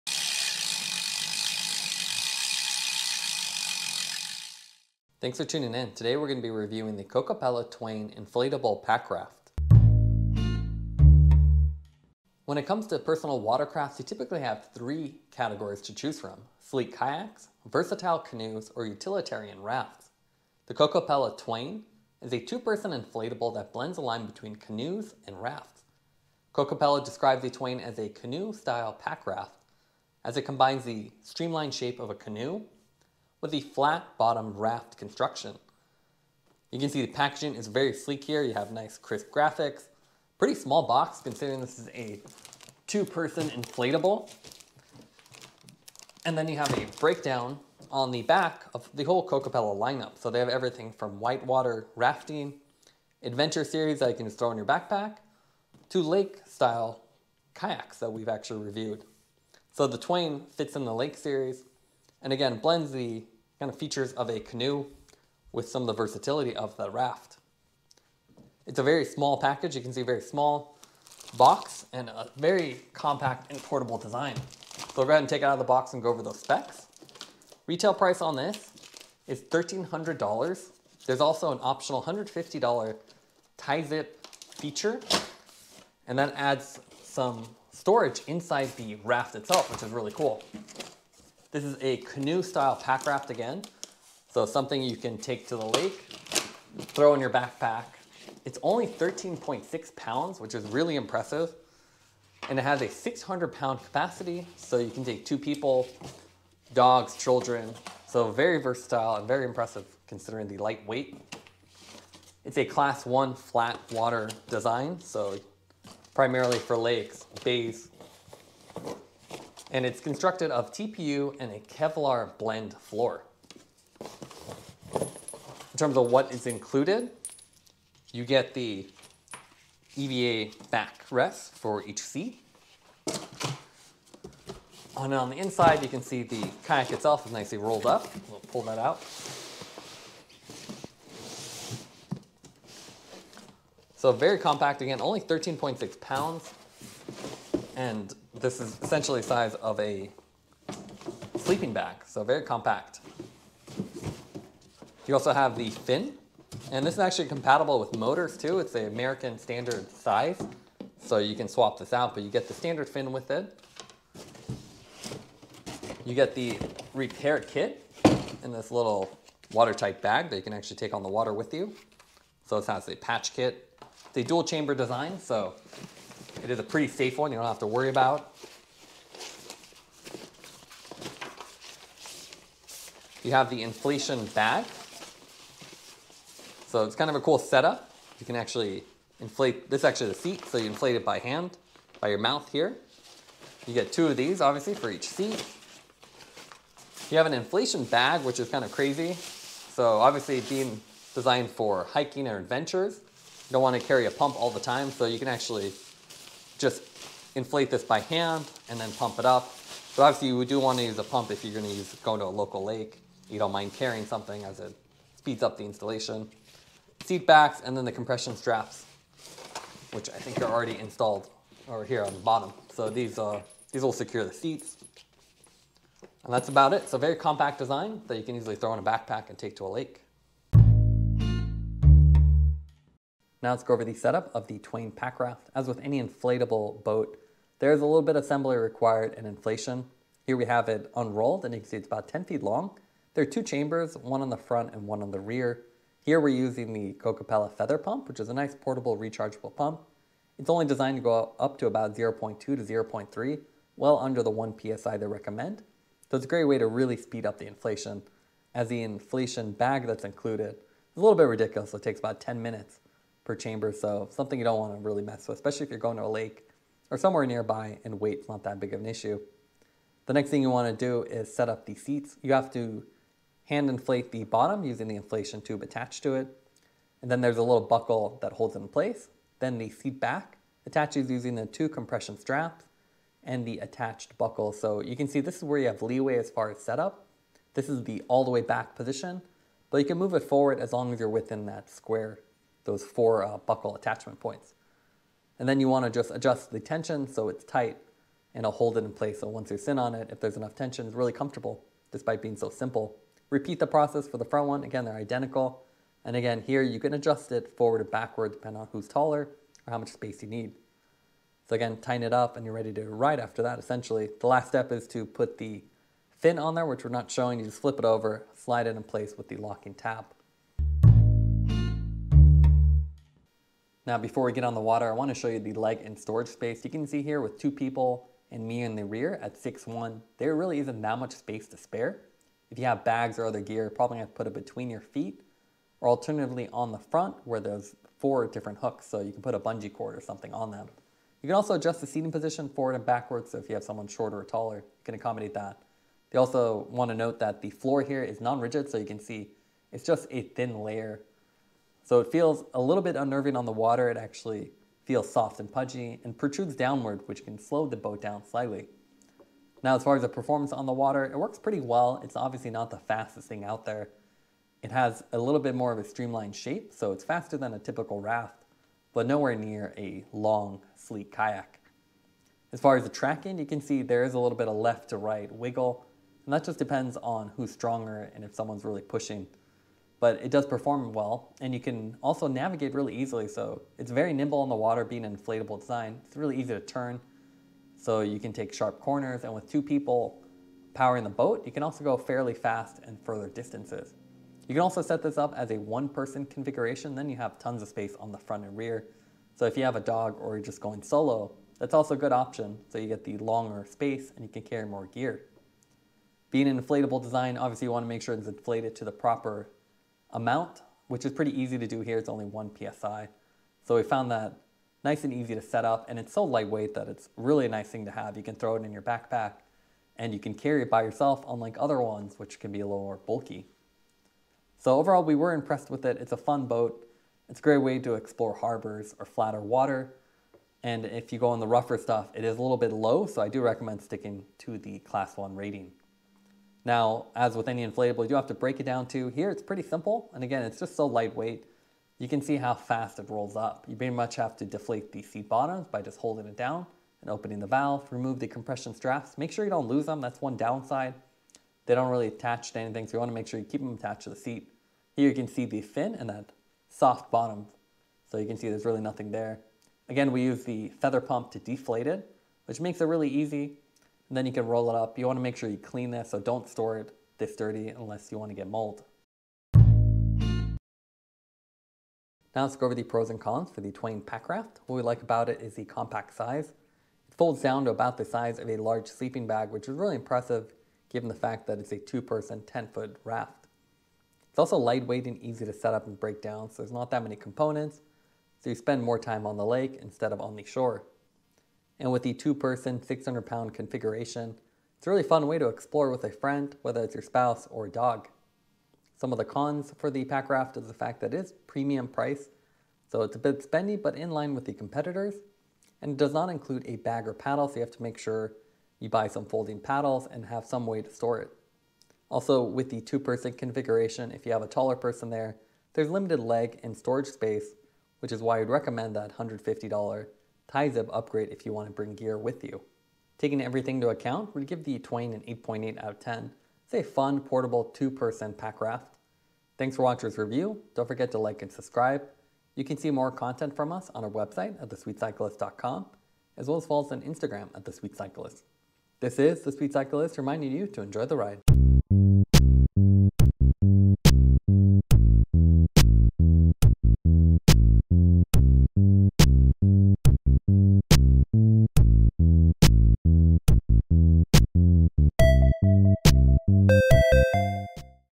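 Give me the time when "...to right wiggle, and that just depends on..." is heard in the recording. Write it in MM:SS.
06:14.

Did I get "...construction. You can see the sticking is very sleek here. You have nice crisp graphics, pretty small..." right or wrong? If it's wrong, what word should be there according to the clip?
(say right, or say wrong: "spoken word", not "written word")
wrong: "packaging", not "sticking".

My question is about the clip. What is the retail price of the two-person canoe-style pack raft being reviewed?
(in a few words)
$1,300.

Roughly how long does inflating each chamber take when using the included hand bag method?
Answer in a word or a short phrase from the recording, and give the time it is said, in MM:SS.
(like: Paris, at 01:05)
10 minutes, at 04:22.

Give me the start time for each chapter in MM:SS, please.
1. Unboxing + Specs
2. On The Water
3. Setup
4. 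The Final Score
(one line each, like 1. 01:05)
1. 00:10
2. 05:21
3. 03:51
4. 07:50.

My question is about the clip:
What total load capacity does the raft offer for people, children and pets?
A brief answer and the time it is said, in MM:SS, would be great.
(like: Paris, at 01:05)
600 pounds, at 01:42.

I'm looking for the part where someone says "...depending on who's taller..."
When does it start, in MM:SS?
05:08.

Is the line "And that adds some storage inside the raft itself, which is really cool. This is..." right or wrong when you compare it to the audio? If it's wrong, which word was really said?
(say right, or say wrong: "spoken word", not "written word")
right.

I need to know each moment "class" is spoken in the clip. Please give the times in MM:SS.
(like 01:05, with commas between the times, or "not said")
01:52, 07:14.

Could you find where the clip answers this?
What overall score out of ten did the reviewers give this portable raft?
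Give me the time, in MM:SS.
08:45.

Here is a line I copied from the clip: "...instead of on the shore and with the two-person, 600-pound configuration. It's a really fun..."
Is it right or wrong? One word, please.
right.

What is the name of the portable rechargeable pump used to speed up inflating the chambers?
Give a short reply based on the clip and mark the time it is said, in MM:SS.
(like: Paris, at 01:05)
Kokopelli Feather Pump, at 04:06.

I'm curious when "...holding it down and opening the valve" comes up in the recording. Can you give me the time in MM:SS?
07:25.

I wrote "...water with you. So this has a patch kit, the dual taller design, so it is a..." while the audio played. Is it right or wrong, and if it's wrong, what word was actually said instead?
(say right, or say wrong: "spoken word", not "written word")
wrong: "chamber", not "taller".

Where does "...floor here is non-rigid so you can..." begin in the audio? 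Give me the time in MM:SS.
05:47.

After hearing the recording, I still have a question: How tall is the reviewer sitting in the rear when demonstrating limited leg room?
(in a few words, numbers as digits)
6'1".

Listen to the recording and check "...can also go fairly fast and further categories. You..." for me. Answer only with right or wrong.
wrong.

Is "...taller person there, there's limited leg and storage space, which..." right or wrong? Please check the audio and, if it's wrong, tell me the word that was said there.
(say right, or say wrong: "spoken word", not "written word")
right.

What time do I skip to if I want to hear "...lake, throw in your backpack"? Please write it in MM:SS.
01:35.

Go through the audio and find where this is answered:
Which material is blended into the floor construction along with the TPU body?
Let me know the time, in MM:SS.
02:01.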